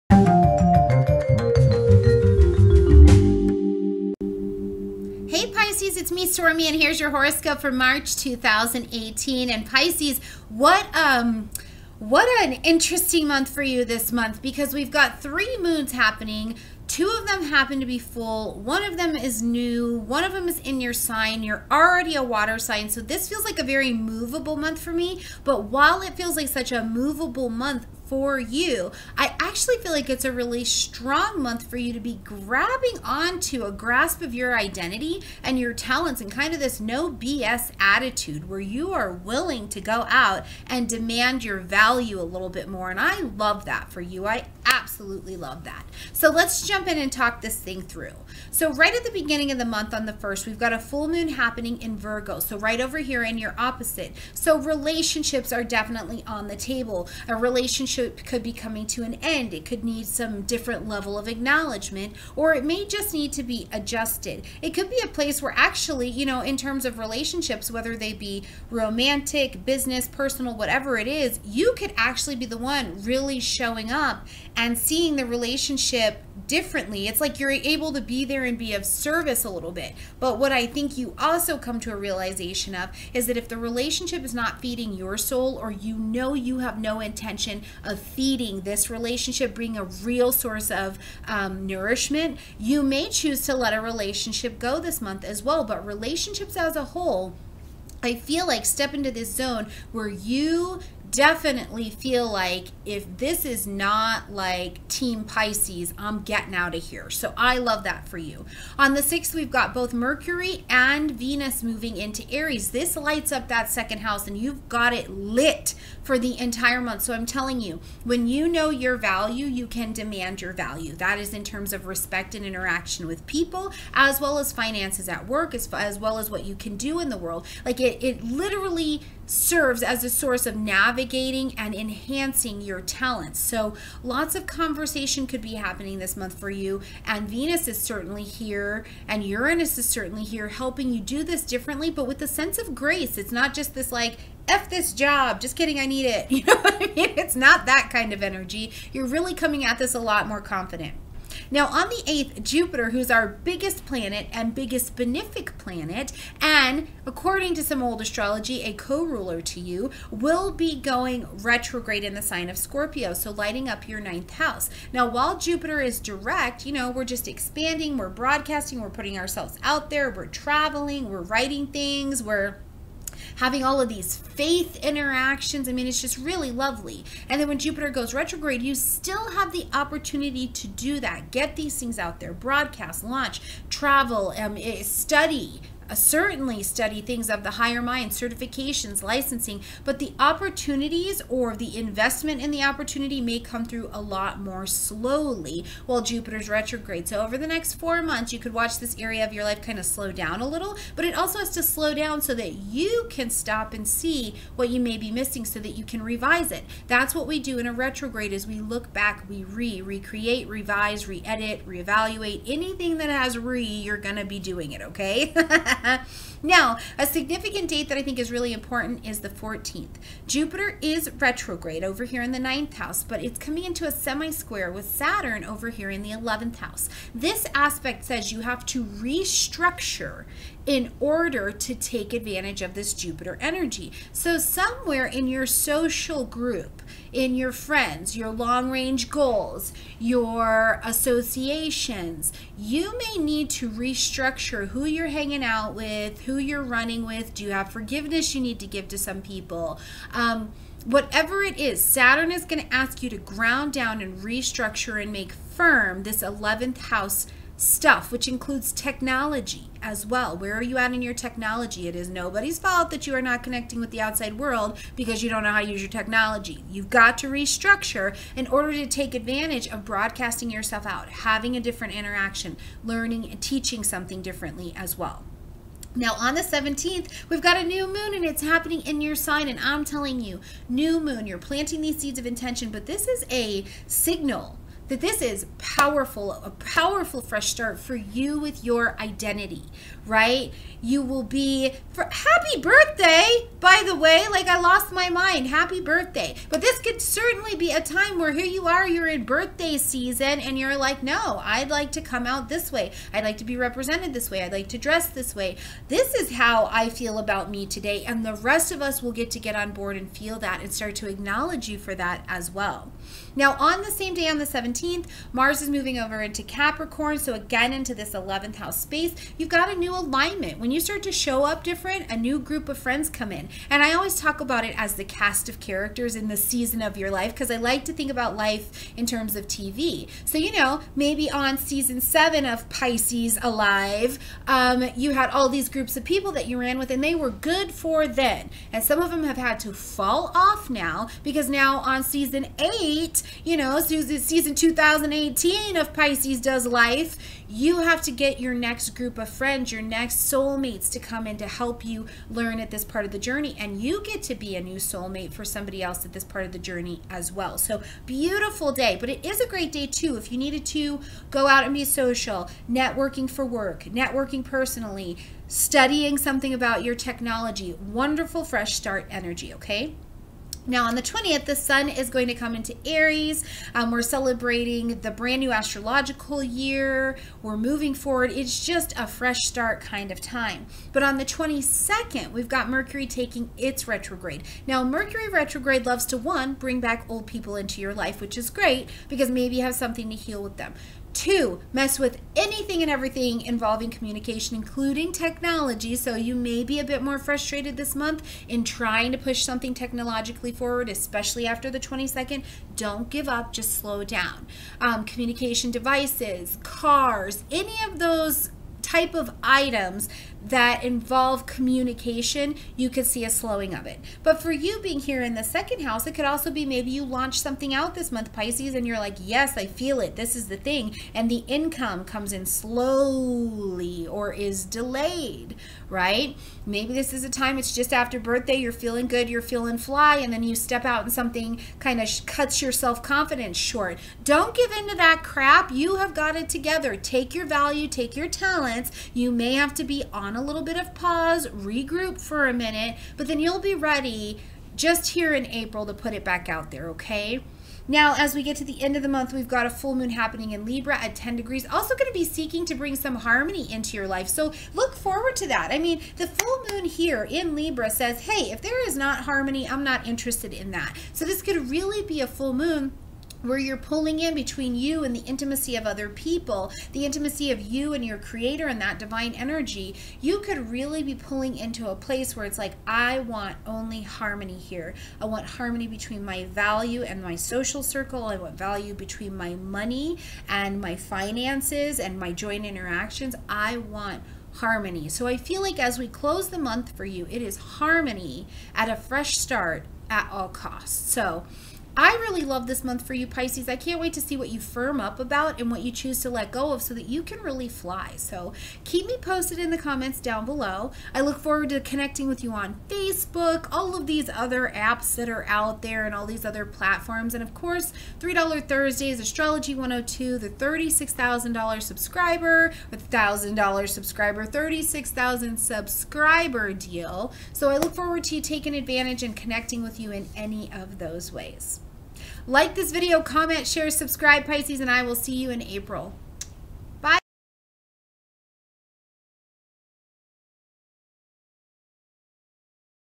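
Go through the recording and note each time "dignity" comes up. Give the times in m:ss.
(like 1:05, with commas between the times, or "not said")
not said.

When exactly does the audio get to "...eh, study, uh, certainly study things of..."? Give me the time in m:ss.
3:04.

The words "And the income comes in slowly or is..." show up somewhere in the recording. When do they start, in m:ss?
7:01.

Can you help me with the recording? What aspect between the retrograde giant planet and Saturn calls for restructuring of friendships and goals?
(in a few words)
semi-square.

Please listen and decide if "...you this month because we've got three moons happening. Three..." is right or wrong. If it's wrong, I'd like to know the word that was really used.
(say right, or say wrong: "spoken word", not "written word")
wrong: "Two", not "Three".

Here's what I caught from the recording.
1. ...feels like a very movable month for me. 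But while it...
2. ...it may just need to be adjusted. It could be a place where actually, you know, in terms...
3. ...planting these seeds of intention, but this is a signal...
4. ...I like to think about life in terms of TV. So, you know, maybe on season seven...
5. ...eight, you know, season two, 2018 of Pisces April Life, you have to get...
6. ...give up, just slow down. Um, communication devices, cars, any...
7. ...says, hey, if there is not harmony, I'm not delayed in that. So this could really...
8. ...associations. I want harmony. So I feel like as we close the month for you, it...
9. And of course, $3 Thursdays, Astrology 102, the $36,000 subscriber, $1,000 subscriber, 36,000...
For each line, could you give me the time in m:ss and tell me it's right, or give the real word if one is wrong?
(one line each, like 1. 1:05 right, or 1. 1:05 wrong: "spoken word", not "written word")
1. 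0:23 right
2. 1:02 right
3. 4:41 right
4. 5:27 right
5. 5:42 wrong: "Does", not "April"
6. 6:43 right
7. 7:37 wrong: "interested", not "delayed"
8. 8:02 wrong: "interactions", not "associations"
9. 8:27 right.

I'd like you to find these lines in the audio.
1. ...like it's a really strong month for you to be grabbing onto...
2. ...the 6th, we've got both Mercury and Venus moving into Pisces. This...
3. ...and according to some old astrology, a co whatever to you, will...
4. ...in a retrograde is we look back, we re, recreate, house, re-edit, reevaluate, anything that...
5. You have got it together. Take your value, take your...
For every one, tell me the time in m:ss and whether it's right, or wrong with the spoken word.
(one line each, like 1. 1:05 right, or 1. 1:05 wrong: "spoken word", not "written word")
1. 0:29 right
2. 1:48 wrong: "Aries", not "Pisces"
3. 2:36 wrong: "ruler", not "whatever"
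4. 3:27 wrong: "revise", not "house"
5. 7:15 right.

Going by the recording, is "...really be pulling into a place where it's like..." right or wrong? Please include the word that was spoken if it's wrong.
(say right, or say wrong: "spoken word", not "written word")
right.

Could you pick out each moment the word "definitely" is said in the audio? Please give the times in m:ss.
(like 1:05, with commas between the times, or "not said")
0:55, 1:41.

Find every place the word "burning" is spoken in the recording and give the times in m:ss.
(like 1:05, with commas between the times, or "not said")
not said.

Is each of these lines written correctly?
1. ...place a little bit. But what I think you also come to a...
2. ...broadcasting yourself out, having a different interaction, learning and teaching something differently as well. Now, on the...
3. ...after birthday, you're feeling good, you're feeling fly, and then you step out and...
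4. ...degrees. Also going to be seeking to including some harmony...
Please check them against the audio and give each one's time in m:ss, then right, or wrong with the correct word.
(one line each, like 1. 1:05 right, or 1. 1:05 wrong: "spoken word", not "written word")
1. 1:18 wrong: "service", not "place"
2. 4:29 right
3. 7:07 right
4. 7:31 wrong: "bring", not "including".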